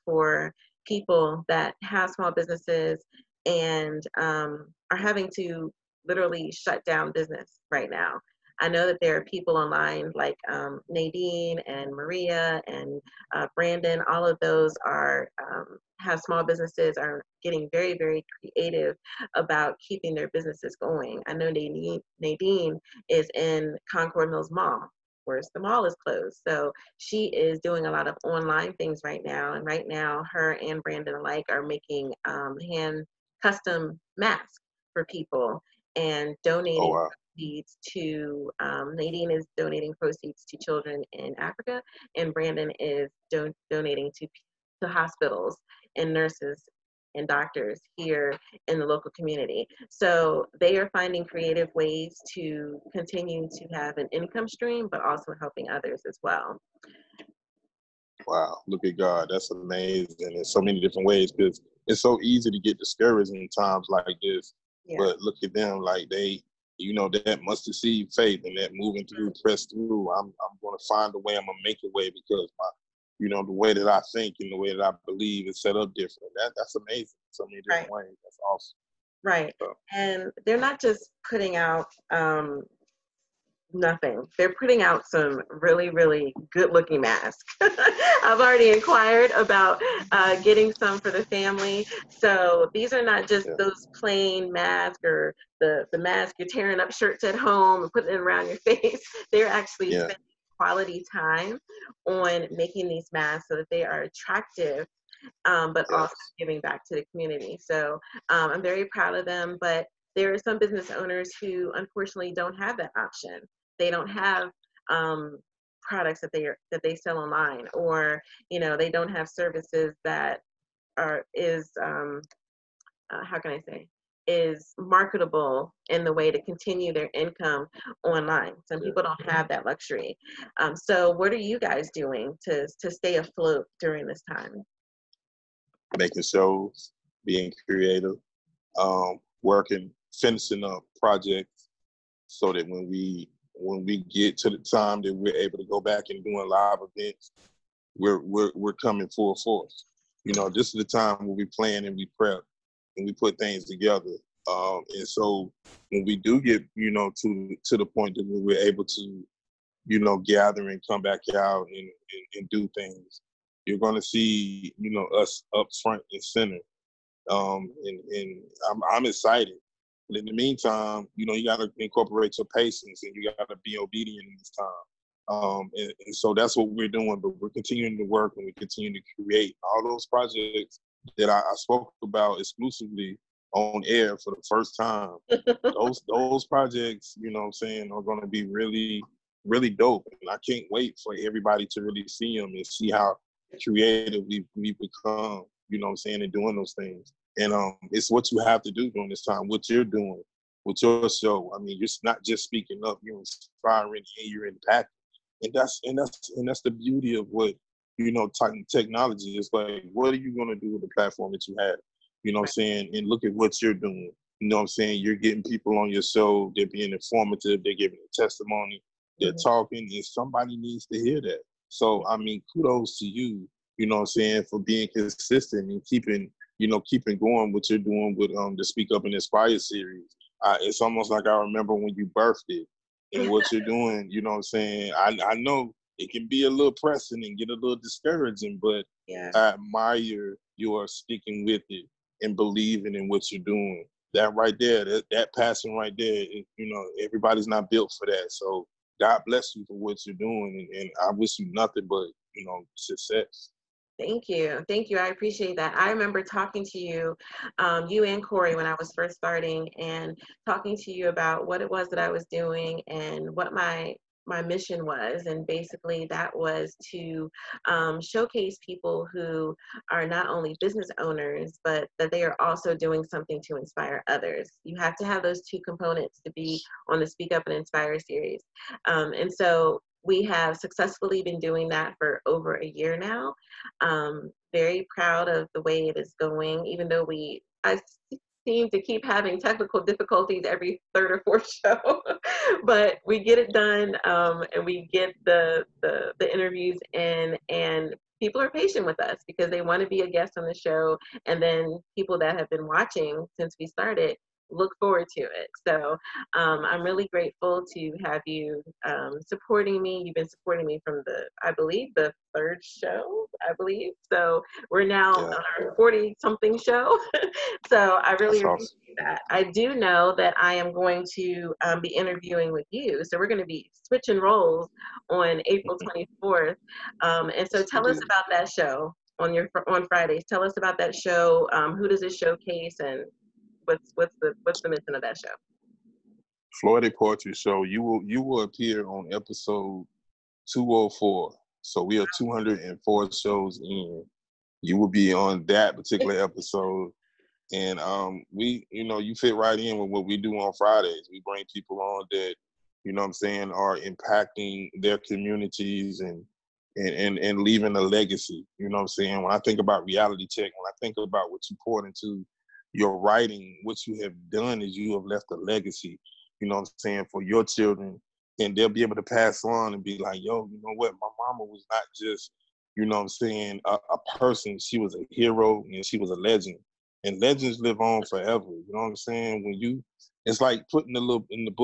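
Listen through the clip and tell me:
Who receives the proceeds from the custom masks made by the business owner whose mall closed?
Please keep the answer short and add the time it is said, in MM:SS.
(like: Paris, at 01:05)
Children in Africa, at 00:40.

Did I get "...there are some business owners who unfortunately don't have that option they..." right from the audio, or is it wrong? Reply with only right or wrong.
right.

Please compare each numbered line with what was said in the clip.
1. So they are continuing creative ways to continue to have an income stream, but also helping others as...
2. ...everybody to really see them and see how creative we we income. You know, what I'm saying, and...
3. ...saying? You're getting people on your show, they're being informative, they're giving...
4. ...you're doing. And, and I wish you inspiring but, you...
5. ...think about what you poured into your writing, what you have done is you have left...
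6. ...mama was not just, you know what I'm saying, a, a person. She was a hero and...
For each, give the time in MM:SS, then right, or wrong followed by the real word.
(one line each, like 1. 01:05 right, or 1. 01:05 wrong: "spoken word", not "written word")
1. 00:49 wrong: "finding", not "continuing"
2. 03:11 wrong: "become", not "income"
3. 03:34 right
4. 04:10 wrong: "nothing", not "inspiring"
5. 06:00 right
6. 06:11 right.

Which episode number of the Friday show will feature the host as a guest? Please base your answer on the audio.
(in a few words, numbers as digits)
204.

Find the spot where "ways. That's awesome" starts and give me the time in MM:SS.
01:18.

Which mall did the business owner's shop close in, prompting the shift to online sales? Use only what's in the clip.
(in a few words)
Concord Mills Mall.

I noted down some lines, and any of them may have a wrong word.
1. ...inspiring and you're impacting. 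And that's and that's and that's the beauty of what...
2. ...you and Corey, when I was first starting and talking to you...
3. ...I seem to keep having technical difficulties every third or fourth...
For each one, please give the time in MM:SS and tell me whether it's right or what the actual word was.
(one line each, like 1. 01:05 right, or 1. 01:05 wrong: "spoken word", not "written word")
1. 03:23 right
2. 04:17 right
3. 04:47 right.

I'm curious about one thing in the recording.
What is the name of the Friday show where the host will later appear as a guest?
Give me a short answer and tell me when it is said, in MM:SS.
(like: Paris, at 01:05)
Floetic Poetry Show, at 05:36.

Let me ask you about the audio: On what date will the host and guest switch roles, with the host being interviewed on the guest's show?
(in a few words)
April 24th.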